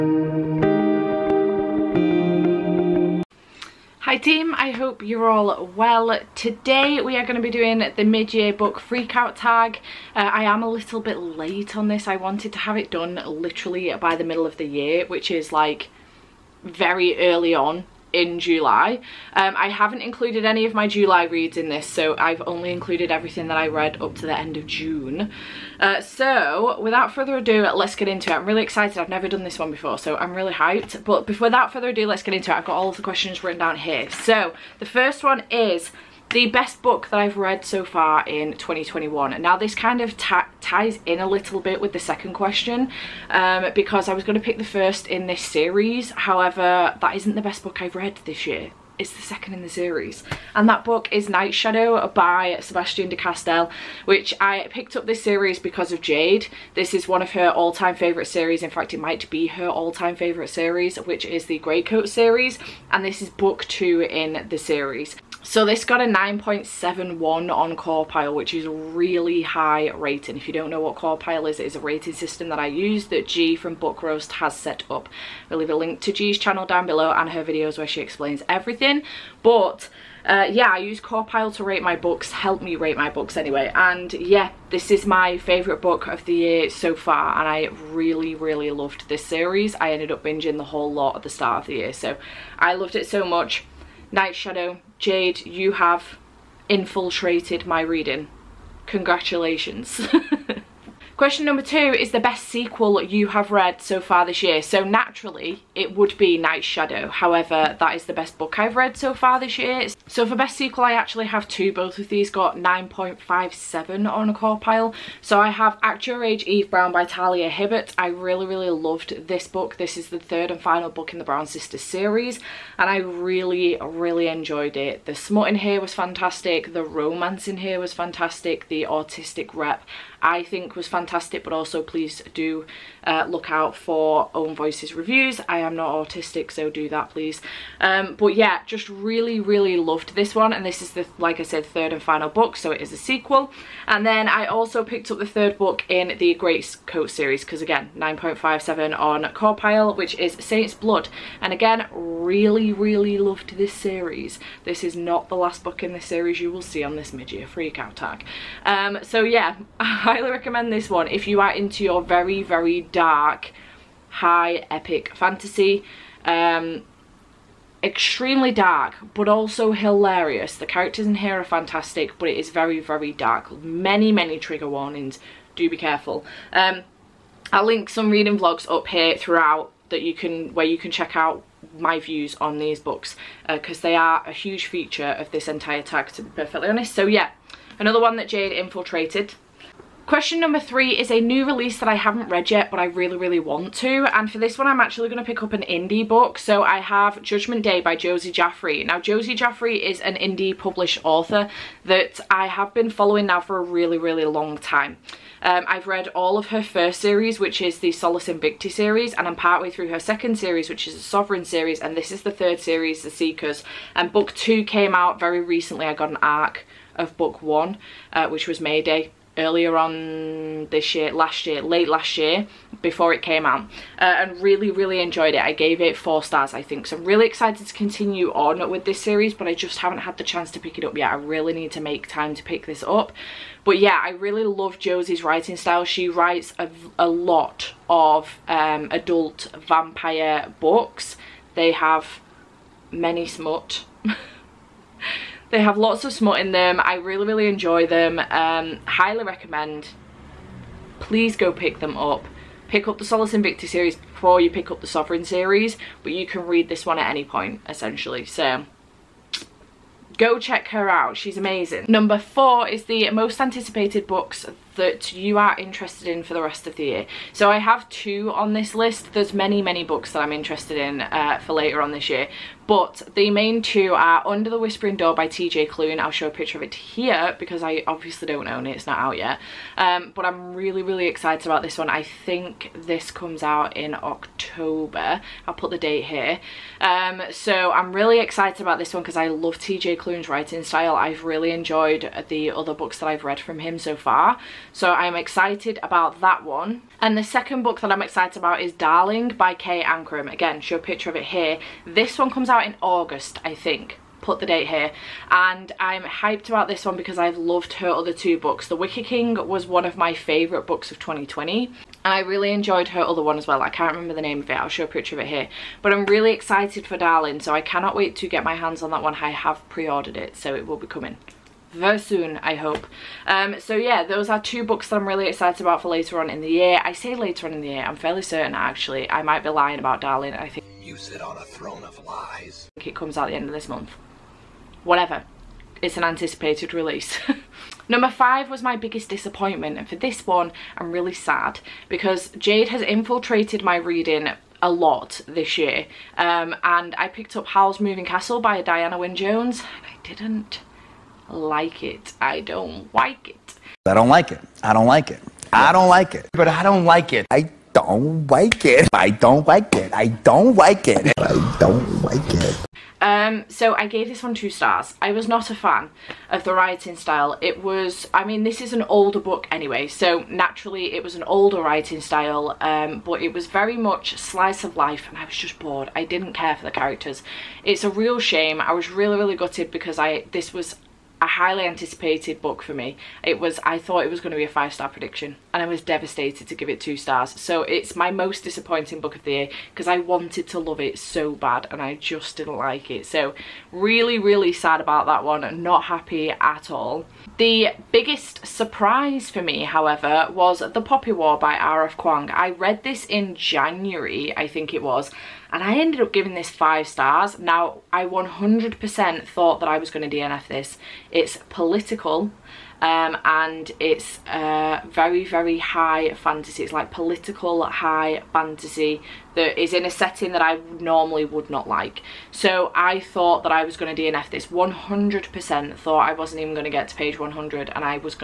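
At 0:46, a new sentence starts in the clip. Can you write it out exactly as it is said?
However, that isn't the best book I've read this year.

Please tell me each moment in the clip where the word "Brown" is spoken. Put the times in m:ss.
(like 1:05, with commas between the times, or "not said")
1:56, 2:01.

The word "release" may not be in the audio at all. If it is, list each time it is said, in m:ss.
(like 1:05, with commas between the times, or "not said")
3:11, 5:36.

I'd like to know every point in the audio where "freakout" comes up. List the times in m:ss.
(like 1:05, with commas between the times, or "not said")
0:08, 2:37.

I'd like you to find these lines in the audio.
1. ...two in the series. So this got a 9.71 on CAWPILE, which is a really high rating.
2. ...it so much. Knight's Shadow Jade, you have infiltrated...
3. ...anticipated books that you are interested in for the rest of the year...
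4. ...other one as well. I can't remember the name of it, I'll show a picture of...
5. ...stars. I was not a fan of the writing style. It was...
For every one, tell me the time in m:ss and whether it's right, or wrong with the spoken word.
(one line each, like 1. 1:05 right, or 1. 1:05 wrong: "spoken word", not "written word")
1. 1:03 right
2. 1:32 right
3. 4:23 right
4. 5:13 right
5. 6:04 right.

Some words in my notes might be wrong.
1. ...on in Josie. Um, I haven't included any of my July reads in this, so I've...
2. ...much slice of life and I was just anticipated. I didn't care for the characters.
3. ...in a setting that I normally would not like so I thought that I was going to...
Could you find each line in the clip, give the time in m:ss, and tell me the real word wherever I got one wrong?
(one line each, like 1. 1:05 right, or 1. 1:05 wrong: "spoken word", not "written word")
1. 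0:17 wrong: "July", not "Josie"
2. 6:13 wrong: "bored", not "anticipated"
3. 6:59 right.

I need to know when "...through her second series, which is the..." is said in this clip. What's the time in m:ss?
3:29.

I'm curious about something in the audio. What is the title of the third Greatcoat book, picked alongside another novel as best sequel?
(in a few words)
Saints Blood.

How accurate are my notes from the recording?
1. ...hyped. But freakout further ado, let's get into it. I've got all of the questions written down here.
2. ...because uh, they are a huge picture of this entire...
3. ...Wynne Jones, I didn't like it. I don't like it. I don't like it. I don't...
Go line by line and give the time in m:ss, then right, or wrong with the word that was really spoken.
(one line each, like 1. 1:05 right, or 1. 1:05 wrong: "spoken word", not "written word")
1. 0:30 wrong: "without", not "freakout"
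2. 3:03 wrong: "feature", not "picture"
3. 5:48 right.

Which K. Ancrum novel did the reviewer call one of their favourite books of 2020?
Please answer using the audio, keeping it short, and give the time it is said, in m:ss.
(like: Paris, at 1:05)
The Wicker King, at 5:08.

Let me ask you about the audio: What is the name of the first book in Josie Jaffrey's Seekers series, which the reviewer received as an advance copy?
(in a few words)
Mayday.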